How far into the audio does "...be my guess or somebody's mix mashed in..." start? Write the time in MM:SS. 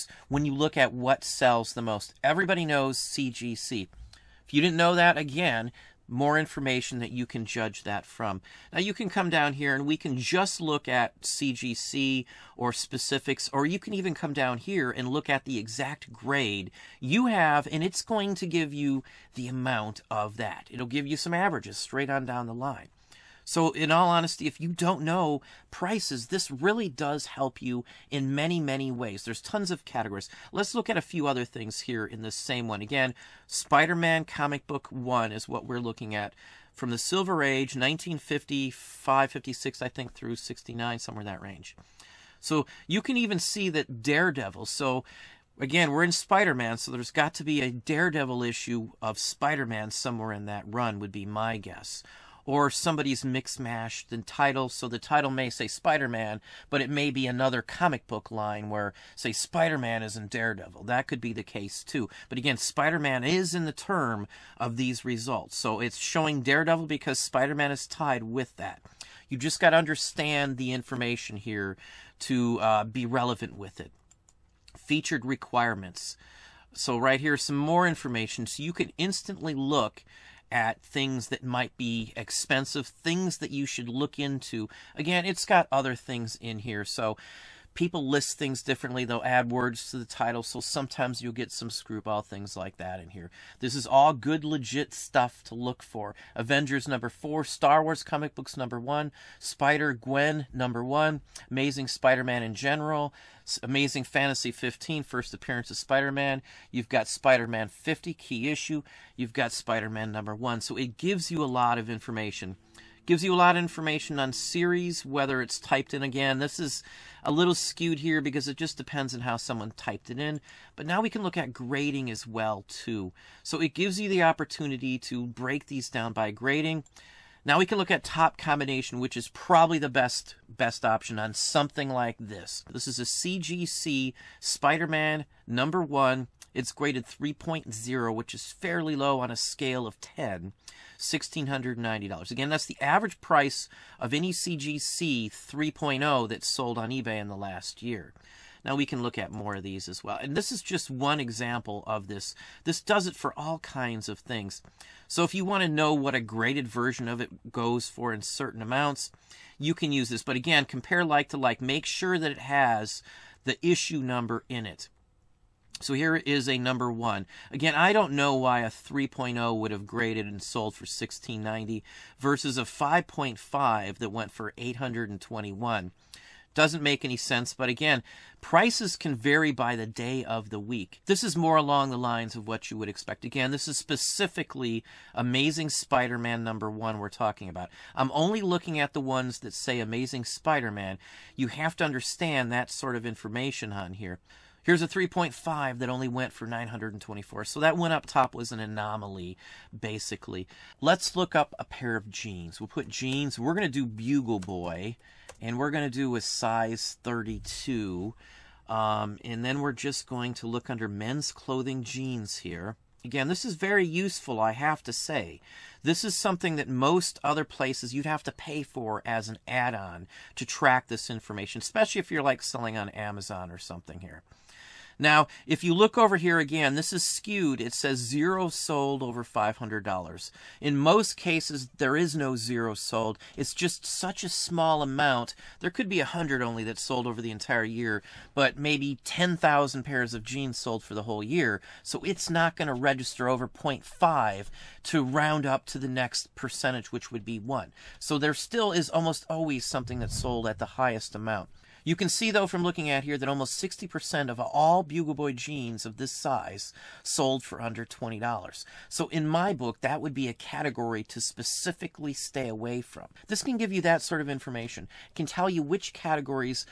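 00:51.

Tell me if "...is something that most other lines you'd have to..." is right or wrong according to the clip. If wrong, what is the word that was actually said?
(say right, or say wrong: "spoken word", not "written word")
wrong: "places", not "lines".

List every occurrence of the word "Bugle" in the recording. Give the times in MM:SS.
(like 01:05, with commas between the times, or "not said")
03:23, 04:14.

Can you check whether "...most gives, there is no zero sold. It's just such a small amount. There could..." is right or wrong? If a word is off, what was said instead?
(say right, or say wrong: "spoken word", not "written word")
wrong: "cases", not "gives".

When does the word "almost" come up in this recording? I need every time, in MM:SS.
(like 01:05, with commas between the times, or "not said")
04:08, 04:13.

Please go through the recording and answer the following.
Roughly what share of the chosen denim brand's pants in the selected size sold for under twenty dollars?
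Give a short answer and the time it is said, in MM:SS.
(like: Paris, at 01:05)
60%, at 04:13.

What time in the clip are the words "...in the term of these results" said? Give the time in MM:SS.
01:03.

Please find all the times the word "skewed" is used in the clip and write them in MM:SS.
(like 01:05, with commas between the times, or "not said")
01:57, 03:47.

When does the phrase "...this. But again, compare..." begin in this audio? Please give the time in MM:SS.
02:40.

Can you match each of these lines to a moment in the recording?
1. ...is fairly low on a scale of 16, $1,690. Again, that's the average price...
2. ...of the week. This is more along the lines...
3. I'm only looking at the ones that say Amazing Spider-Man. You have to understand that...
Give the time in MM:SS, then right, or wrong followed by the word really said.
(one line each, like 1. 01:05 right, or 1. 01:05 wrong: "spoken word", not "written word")
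1. 02:18 wrong: "10", not "16"
2. 03:00 right
3. 03:07 right.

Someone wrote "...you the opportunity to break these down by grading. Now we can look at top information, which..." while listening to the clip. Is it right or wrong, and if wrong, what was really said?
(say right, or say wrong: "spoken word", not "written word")
wrong: "combination", not "information".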